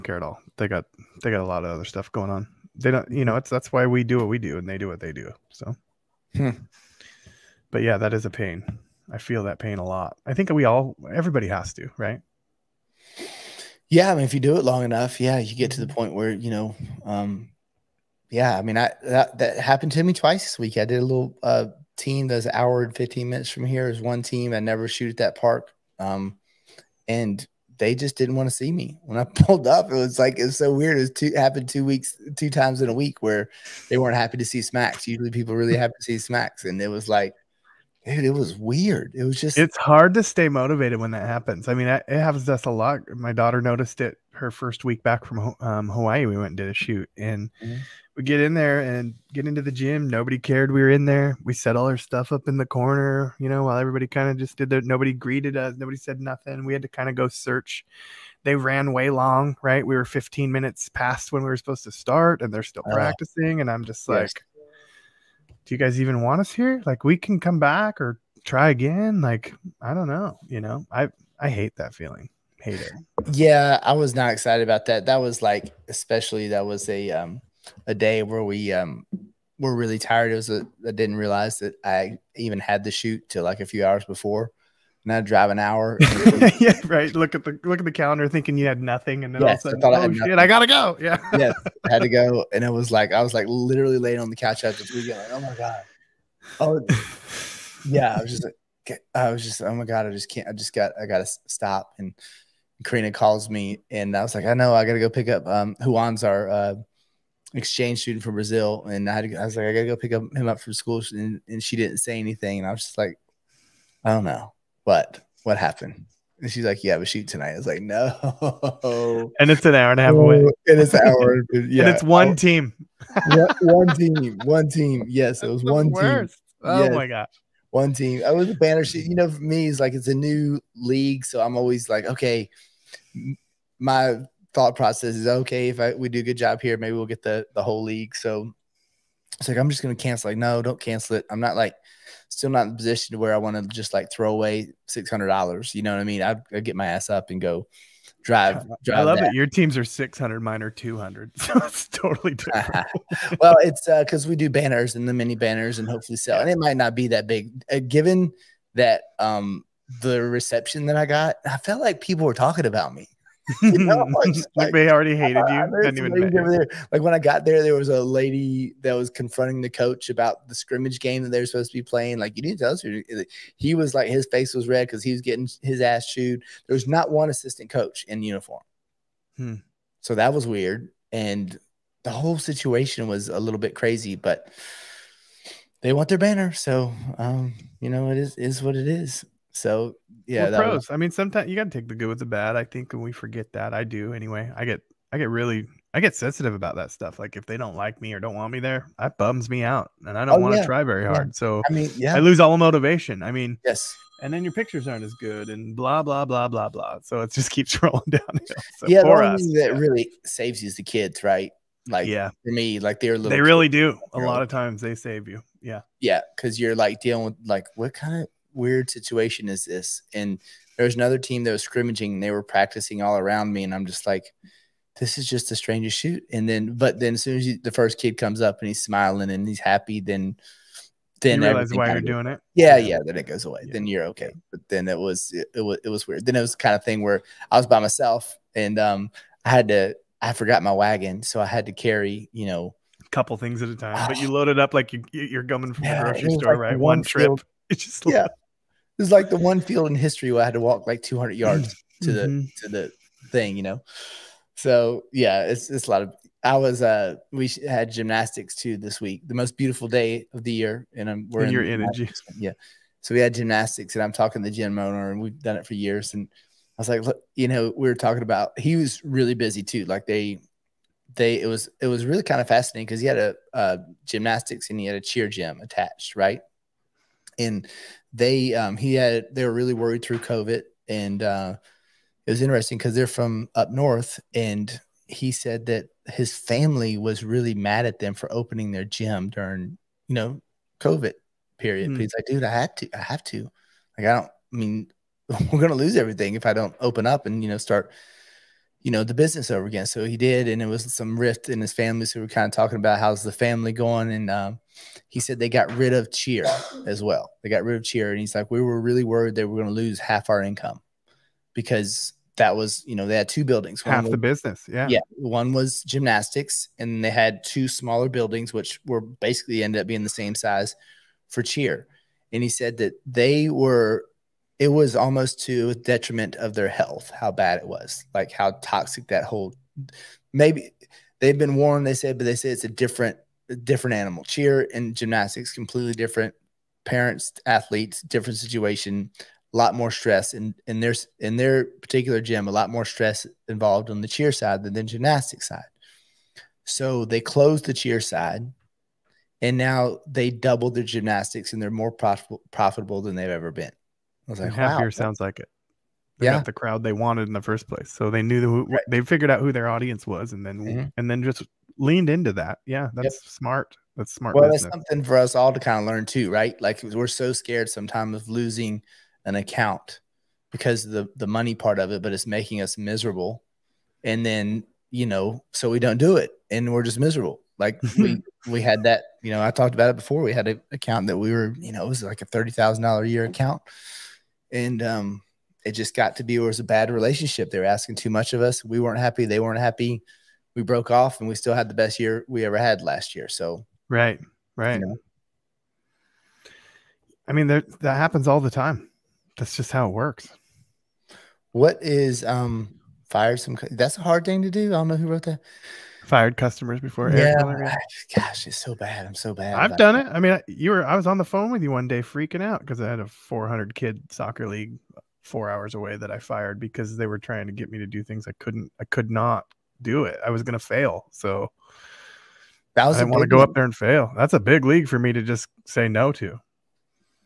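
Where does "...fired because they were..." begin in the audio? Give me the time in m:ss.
6:56.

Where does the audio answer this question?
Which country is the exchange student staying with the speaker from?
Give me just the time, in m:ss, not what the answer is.
1:48.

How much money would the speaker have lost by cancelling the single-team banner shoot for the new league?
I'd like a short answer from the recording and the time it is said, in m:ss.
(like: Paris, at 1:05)
$600, at 2:24.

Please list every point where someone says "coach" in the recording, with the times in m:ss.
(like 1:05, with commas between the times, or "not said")
2:49, 2:57.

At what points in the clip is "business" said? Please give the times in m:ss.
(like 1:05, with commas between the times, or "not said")
4:59, 5:14, 6:04.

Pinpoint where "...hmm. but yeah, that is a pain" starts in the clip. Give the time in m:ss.
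0:06.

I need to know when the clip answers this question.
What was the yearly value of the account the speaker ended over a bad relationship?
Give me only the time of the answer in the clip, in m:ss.
6:22.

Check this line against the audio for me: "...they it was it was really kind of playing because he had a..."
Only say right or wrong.
wrong.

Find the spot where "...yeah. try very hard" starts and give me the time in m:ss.
3:20.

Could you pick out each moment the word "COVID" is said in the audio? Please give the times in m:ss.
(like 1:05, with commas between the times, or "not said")
4:40, 4:50.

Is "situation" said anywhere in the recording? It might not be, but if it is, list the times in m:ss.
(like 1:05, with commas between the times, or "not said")
3:02, 3:38, 5:38.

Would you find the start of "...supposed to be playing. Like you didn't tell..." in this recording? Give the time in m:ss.
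2:51.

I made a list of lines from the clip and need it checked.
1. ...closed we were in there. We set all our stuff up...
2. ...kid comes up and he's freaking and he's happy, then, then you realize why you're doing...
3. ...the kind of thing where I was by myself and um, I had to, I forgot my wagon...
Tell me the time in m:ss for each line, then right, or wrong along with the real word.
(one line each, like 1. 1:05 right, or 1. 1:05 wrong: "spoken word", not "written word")
1. 0:50 wrong: "cared", not "closed"
2. 3:47 wrong: "smiling", not "freaking"
3. 3:56 right.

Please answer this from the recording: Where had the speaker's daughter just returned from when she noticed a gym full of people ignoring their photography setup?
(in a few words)
Hawaii.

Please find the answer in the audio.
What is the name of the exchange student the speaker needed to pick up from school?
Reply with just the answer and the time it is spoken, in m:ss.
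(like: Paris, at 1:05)
Juan, at 1:45.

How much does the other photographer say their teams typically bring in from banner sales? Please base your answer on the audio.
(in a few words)
$200.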